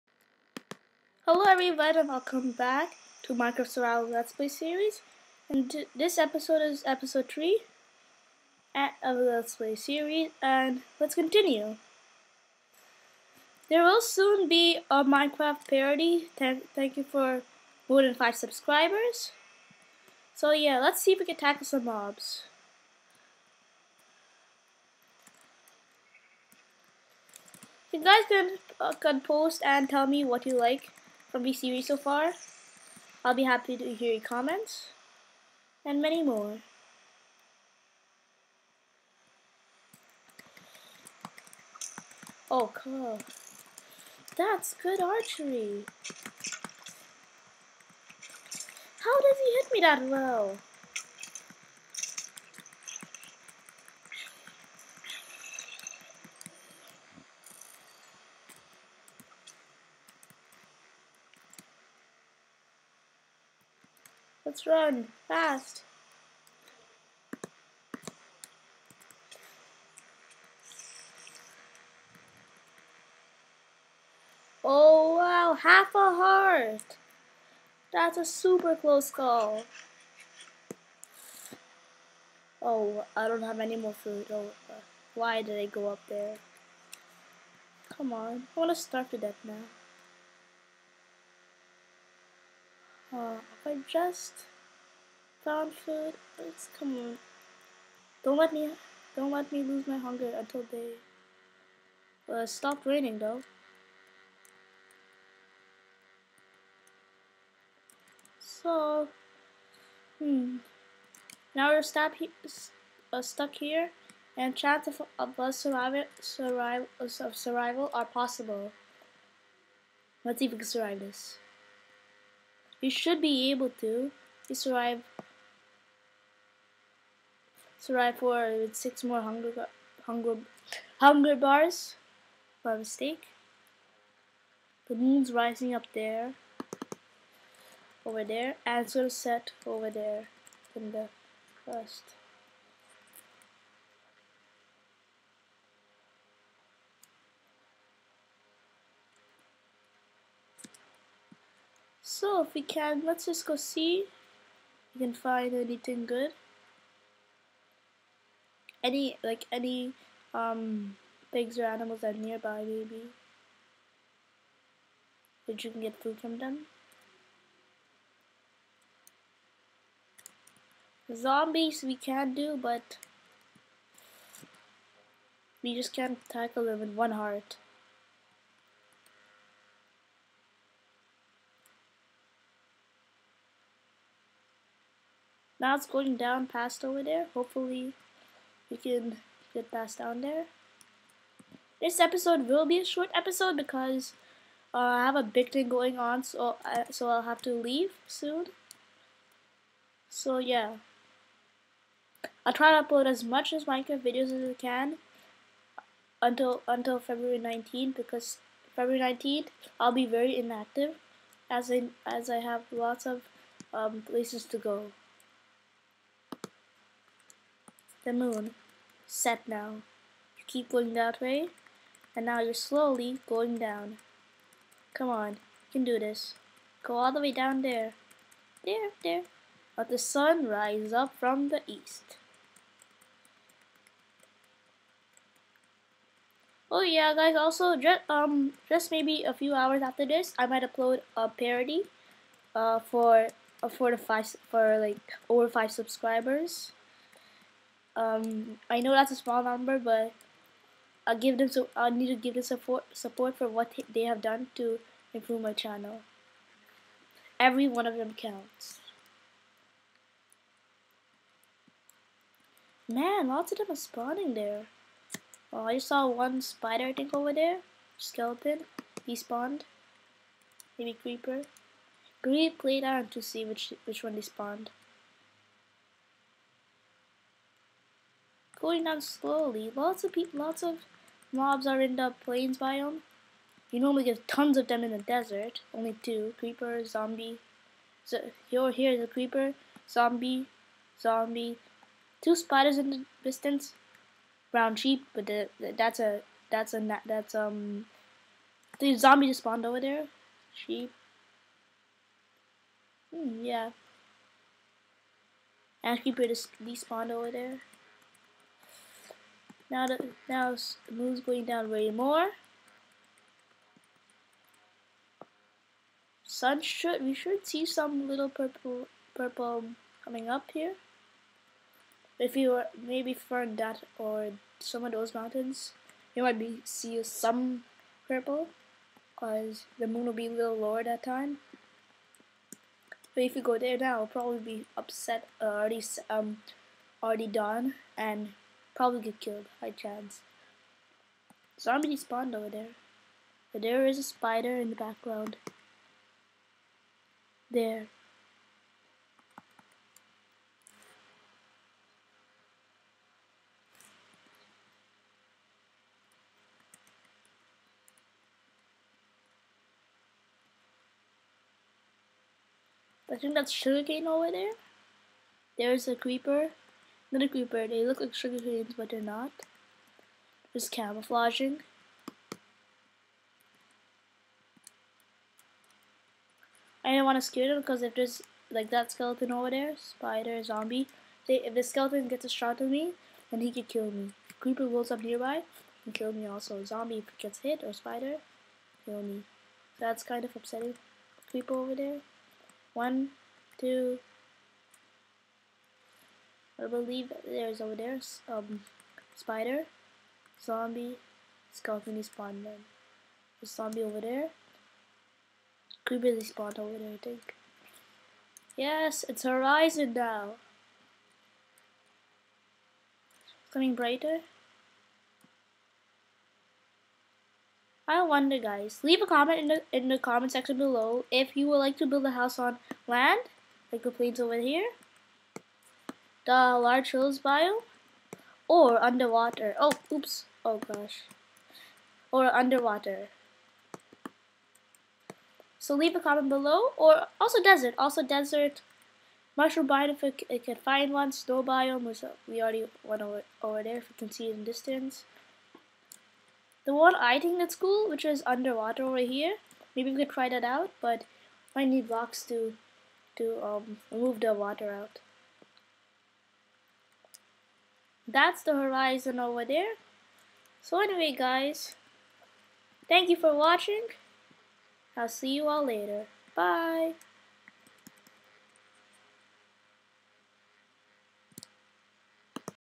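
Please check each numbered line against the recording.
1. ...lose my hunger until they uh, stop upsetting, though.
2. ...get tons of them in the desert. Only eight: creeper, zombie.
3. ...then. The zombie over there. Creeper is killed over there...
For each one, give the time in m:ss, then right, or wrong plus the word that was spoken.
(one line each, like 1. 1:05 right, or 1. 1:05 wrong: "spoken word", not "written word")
1. 1:39 wrong: "raining", not "upsetting"
2. 4:44 wrong: "two", not "eight"
3. 6:42 wrong: "spawned", not "killed".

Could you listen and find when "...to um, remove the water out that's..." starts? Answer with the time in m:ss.
7:33.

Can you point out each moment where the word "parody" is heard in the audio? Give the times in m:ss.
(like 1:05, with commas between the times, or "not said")
0:15, 4:01.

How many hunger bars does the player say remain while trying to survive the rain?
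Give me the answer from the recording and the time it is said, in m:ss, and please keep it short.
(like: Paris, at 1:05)
6, at 2:08.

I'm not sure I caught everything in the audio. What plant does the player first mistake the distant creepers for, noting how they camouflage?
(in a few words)
sugarcane.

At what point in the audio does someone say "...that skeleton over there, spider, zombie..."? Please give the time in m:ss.
6:18.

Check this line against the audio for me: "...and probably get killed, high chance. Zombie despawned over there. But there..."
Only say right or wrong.
wrong.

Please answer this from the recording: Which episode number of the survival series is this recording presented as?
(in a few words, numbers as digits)
3.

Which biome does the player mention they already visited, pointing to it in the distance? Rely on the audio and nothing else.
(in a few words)
Snow biome.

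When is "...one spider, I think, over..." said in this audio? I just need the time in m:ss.
4:26.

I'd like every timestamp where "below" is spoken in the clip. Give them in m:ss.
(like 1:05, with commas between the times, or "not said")
7:00, 7:16.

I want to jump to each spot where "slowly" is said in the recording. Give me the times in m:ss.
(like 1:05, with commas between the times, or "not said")
3:42, 4:39.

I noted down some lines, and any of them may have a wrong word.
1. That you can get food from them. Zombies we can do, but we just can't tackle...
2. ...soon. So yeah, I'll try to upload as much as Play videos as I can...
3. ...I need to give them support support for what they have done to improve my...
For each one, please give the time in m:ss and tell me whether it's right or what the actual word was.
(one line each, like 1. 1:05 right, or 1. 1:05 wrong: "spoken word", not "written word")
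1. 2:45 right
2. 3:18 wrong: "Minecraft", not "Play"
3. 4:11 right.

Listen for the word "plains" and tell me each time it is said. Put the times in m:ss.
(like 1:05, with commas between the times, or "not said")
4:42, 7:03.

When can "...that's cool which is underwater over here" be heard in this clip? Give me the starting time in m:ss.
7:27.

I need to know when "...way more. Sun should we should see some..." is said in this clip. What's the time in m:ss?
5:11.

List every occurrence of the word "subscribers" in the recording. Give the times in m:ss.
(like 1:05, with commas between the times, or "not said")
0:18, 4:05.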